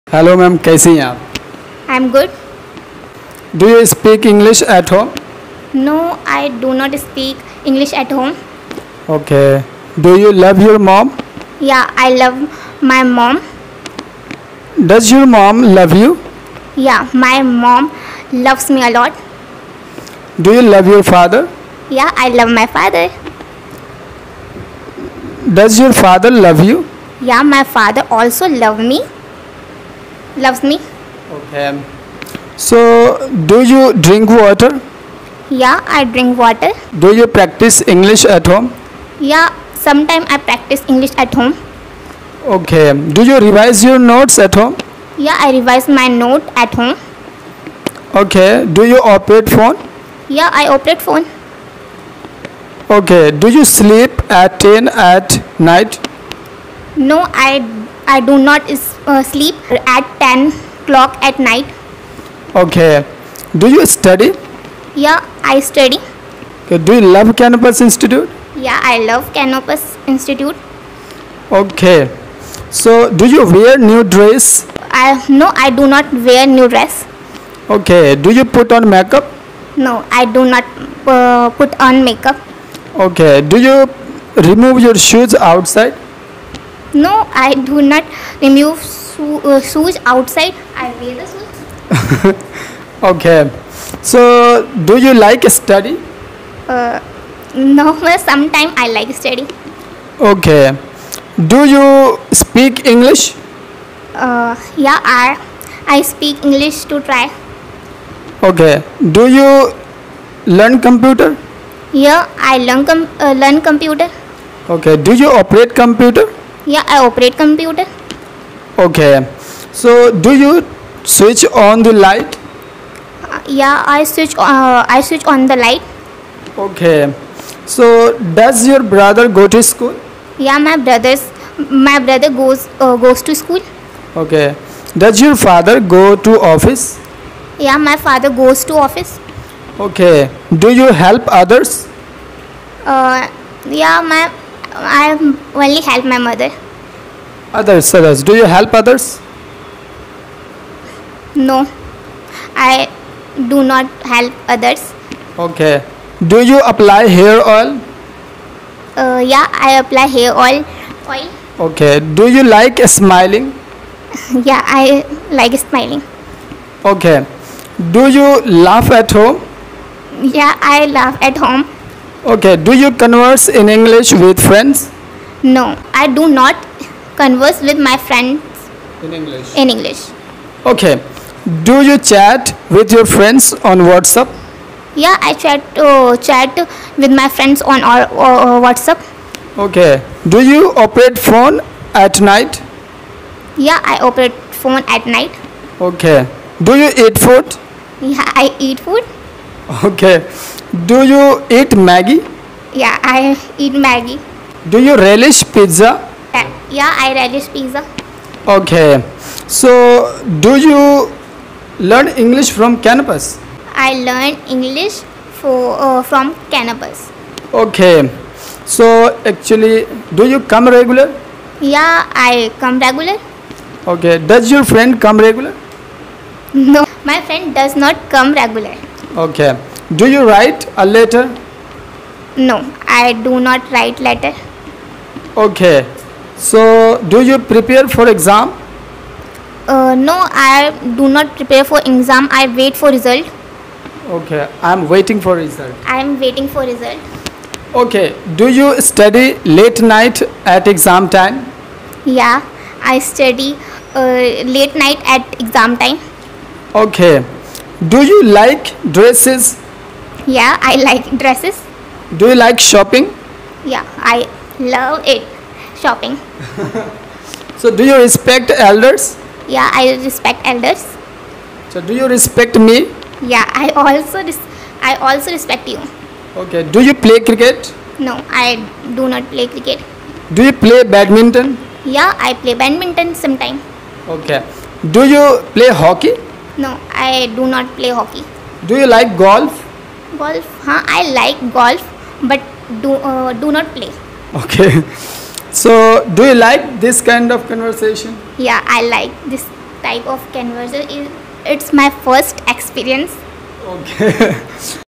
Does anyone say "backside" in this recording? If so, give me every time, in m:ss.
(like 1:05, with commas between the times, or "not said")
not said.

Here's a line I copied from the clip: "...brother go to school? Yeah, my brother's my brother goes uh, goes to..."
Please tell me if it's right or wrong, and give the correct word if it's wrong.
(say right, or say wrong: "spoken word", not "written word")
right.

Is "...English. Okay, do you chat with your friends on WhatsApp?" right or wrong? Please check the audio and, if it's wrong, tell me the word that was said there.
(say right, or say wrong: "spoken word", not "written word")
right.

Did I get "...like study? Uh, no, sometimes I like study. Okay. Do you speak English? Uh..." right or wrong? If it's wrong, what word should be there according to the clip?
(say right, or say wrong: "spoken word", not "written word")
right.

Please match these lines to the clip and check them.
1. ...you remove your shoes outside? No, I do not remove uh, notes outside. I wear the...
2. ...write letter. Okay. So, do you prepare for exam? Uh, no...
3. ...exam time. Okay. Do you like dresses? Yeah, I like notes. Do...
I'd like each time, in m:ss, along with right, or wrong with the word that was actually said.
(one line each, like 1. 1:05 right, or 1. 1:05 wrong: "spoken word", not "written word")
1. 1:23 wrong: "shoes", not "notes"
2. 3:53 right
3. 4:15 wrong: "dresses", not "notes".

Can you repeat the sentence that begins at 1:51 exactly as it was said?
Yeah, I learn com- uh, learn computer.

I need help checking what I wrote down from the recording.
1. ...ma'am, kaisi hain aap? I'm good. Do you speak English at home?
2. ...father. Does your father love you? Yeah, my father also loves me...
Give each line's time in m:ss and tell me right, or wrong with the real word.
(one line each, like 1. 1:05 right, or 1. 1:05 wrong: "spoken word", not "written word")
1. 0:00 right
2. 0:22 right.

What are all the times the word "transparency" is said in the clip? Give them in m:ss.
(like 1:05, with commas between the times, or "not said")
not said.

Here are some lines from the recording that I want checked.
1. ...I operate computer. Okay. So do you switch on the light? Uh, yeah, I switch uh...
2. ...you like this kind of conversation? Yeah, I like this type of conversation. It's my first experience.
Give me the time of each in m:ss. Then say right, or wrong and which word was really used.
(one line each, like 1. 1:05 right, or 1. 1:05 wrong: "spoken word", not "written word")
1. 1:56 right
2. 4:56 right.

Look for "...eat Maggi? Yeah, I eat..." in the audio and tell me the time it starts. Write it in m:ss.
3:21.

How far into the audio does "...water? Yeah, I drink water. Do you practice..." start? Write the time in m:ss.
0:34.